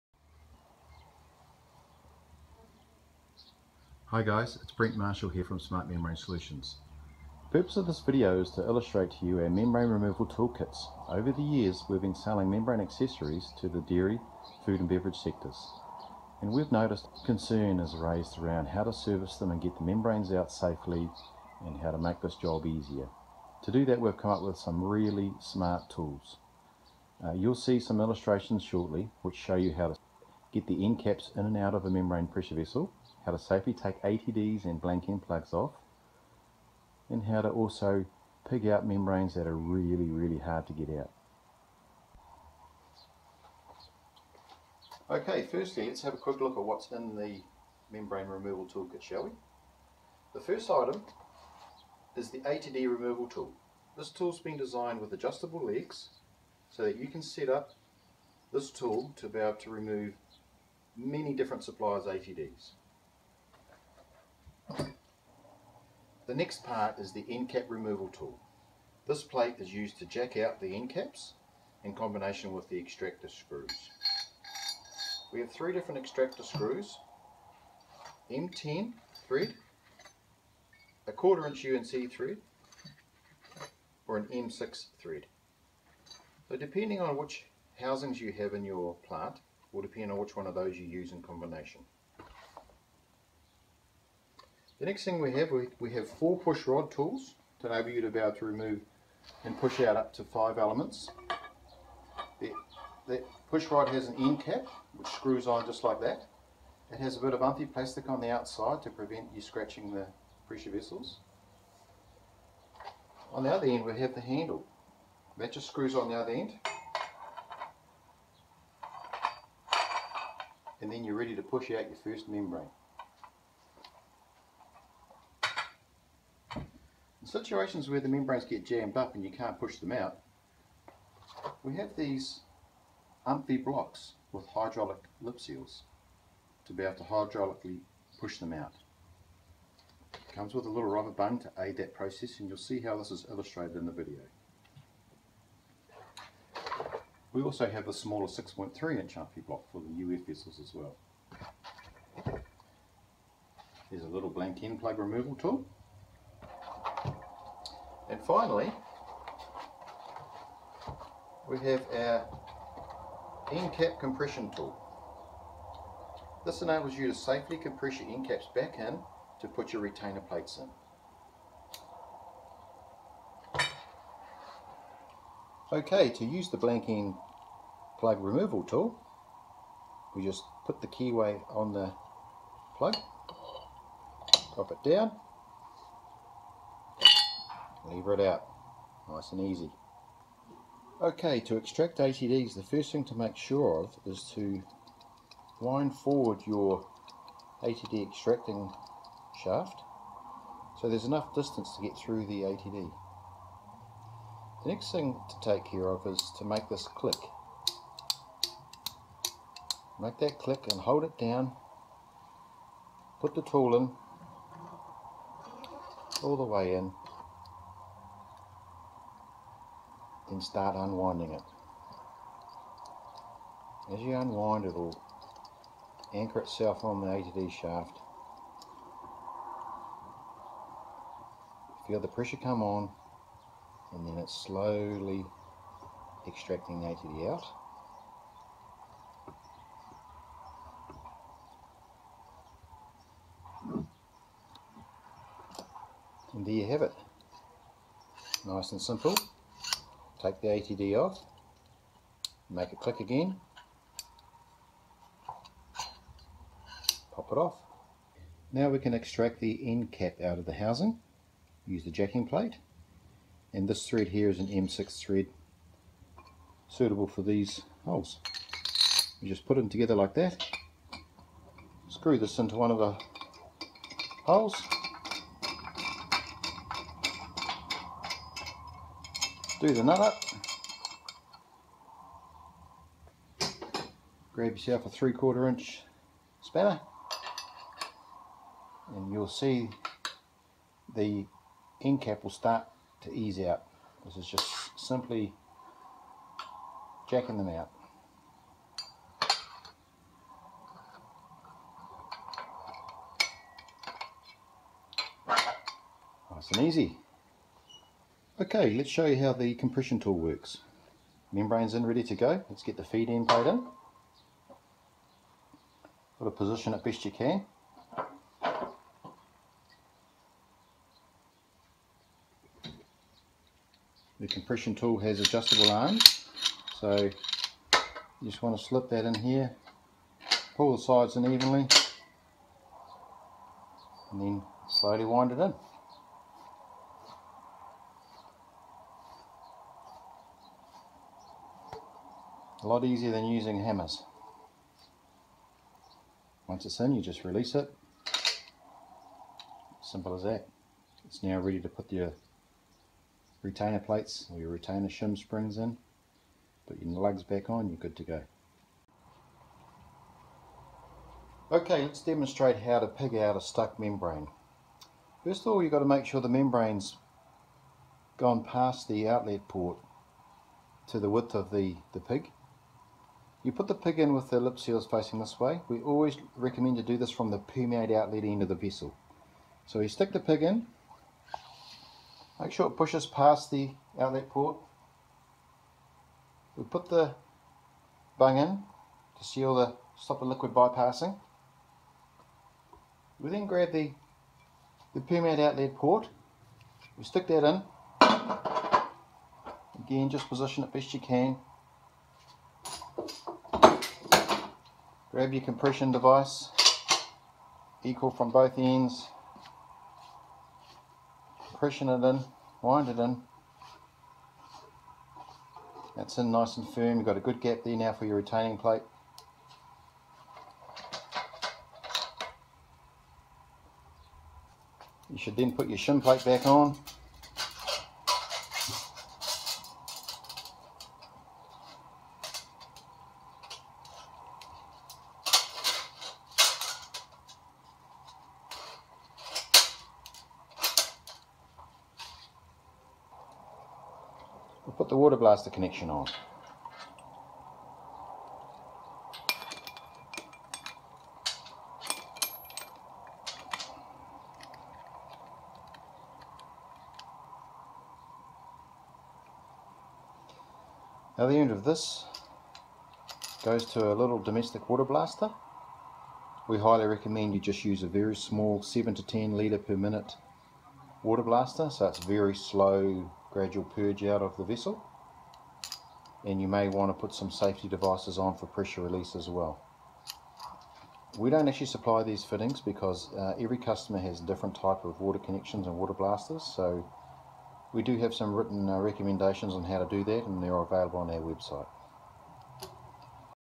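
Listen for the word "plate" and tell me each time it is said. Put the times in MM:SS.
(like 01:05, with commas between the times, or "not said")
01:09, 02:50, 04:22, 05:53, 06:58, 07:06.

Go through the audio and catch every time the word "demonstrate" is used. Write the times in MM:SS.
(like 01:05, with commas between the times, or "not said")
06:02.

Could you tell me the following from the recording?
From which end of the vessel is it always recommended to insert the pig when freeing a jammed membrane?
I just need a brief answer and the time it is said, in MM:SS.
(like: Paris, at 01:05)
Permeate outlet end, at 06:17.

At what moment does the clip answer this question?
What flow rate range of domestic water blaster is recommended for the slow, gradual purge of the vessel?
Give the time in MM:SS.
07:48.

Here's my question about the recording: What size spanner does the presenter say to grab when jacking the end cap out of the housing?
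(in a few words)
Three quarter inch.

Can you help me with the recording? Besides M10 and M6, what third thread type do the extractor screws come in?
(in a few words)
Quarter inch UNC.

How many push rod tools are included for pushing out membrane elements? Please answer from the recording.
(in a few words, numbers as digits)
4.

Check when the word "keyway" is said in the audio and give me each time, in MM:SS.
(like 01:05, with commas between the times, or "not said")
03:00.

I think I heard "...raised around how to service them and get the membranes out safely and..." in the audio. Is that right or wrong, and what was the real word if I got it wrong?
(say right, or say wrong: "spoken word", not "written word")
right.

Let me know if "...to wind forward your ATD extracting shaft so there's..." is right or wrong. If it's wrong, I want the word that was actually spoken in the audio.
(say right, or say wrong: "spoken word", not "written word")
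right.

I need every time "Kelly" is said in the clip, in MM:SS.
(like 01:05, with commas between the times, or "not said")
not said.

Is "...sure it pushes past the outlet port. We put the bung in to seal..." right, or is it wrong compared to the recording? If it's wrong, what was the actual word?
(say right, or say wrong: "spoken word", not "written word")
right.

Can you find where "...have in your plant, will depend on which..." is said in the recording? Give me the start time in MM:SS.
01:28.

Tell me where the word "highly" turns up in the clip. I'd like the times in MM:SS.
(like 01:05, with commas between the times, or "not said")
07:46.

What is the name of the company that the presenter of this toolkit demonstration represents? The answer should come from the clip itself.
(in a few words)
Smart Membrane Solutions.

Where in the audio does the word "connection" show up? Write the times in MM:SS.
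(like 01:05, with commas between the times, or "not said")
07:25, 08:05.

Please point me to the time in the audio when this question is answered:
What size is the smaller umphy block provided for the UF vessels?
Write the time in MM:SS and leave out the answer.
02:28.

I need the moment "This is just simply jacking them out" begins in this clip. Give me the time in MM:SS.
04:54.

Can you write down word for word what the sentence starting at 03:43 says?
As you unwind it will anchor itself on the ATD shaft.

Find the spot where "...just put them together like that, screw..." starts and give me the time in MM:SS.
04:29.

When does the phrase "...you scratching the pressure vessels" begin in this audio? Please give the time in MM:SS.
01:49.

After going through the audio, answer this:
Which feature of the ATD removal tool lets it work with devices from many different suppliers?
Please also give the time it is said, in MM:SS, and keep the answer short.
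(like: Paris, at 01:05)
Adjustable legs, at 00:55.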